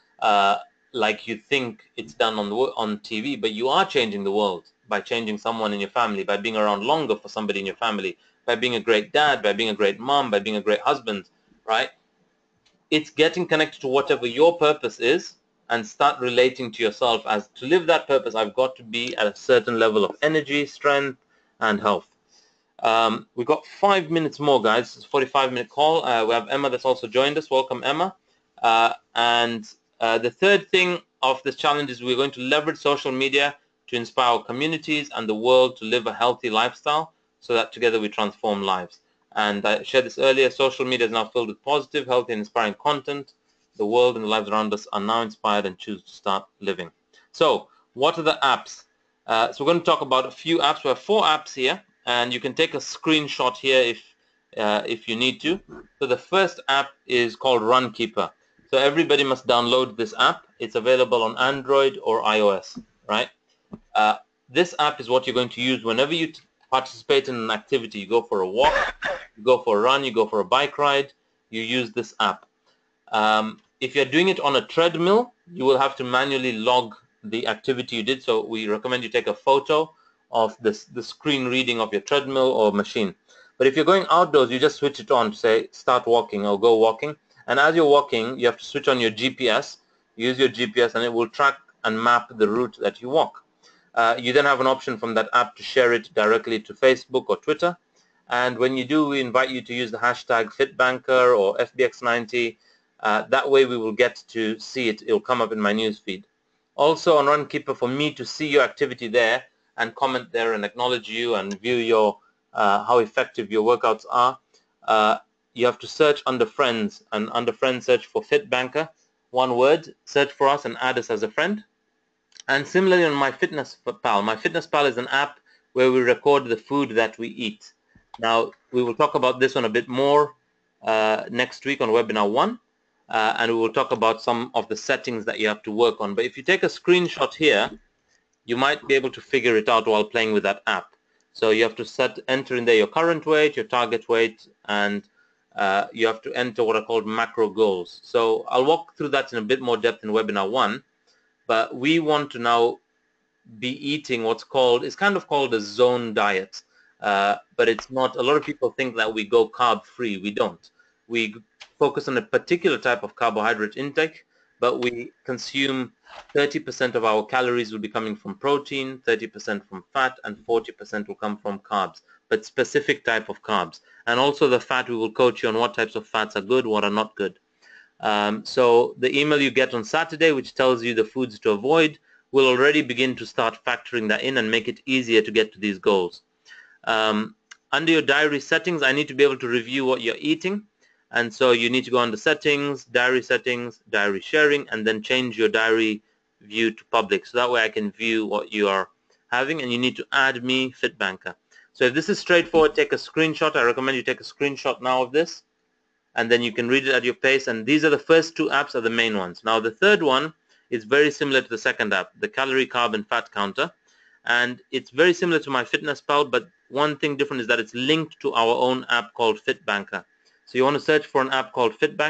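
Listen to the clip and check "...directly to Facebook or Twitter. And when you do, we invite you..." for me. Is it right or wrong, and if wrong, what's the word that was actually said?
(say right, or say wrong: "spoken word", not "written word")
right.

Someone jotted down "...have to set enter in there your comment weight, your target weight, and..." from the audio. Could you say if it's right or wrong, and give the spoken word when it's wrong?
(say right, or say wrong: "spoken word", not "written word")
wrong: "current", not "comment".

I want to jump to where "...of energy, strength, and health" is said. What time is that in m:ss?
0:20.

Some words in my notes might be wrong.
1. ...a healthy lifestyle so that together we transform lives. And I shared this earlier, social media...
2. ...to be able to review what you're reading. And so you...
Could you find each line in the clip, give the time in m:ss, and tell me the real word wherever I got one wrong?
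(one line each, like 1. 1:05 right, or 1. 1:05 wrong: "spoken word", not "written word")
1. 0:36 right
2. 3:09 wrong: "eating", not "reading".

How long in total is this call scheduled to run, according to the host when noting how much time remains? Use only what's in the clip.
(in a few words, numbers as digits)
45 minutes.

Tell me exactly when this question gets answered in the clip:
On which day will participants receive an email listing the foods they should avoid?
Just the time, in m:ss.
2:59.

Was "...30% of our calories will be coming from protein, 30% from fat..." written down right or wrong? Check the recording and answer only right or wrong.
right.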